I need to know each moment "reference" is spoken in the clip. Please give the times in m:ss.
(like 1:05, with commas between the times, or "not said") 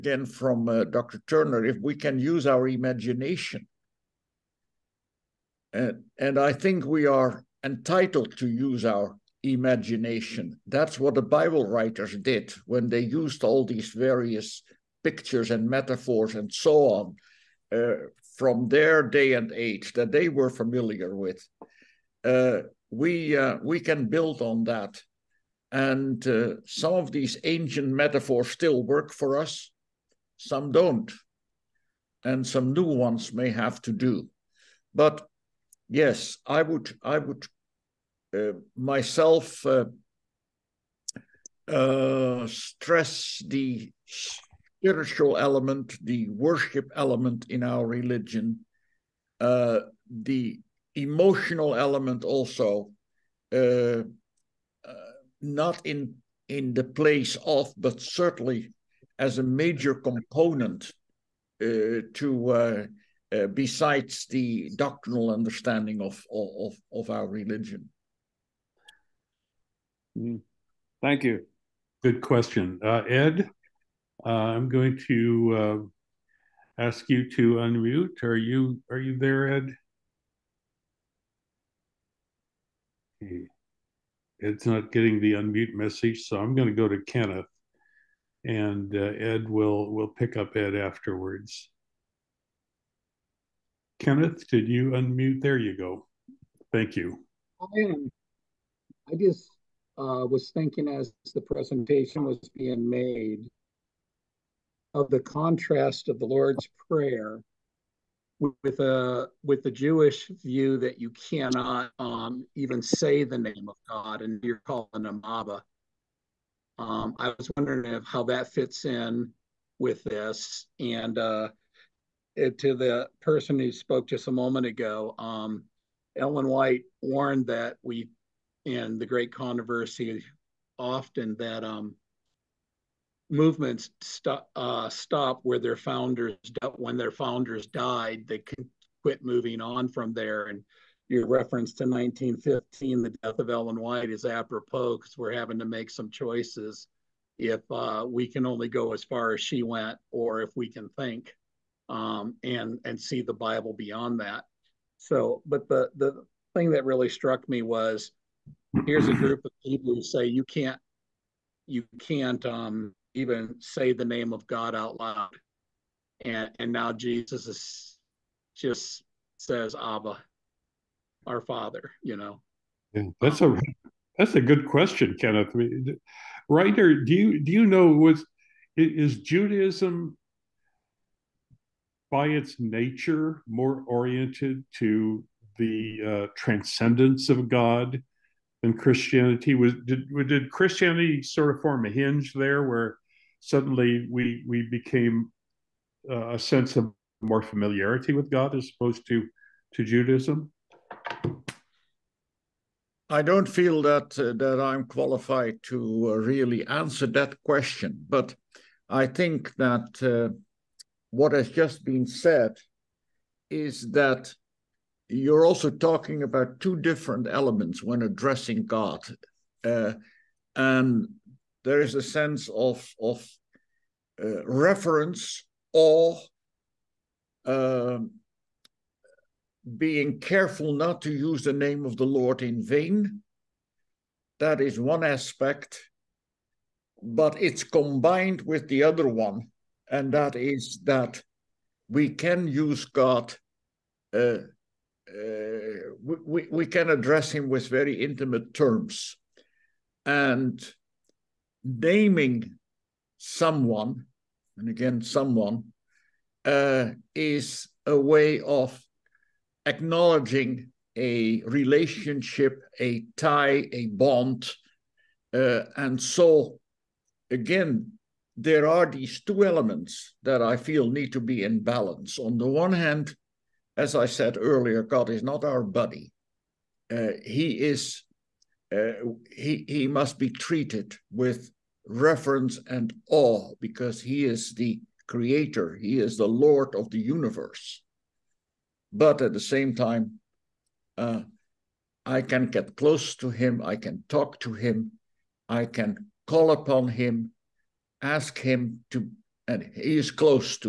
2:21, 3:44.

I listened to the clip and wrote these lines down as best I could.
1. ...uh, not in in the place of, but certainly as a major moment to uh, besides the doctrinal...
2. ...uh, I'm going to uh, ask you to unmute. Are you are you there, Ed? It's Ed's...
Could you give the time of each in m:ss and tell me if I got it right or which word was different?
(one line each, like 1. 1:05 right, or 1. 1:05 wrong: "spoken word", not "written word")
1. 0:54 wrong: "component", not "moment"
2. 1:14 right.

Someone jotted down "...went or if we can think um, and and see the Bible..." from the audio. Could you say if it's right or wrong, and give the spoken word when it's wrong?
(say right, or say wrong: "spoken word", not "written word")
right.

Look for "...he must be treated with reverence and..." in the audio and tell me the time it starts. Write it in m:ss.
4:39.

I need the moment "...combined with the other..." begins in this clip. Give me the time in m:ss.
3:57.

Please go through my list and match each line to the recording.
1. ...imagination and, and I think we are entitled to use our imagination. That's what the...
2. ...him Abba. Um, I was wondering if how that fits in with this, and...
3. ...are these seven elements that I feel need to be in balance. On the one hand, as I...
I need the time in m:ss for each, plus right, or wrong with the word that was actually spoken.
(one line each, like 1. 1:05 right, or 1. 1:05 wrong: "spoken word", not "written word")
1. 0:02 right
2. 1:55 right
3. 4:28 wrong: "two", not "seven".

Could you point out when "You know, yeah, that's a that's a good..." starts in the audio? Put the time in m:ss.
2:52.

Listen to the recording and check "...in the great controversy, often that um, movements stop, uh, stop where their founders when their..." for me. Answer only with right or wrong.
right.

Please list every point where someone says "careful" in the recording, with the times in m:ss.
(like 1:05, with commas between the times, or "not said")
3:50.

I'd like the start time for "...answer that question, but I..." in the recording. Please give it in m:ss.
3:26.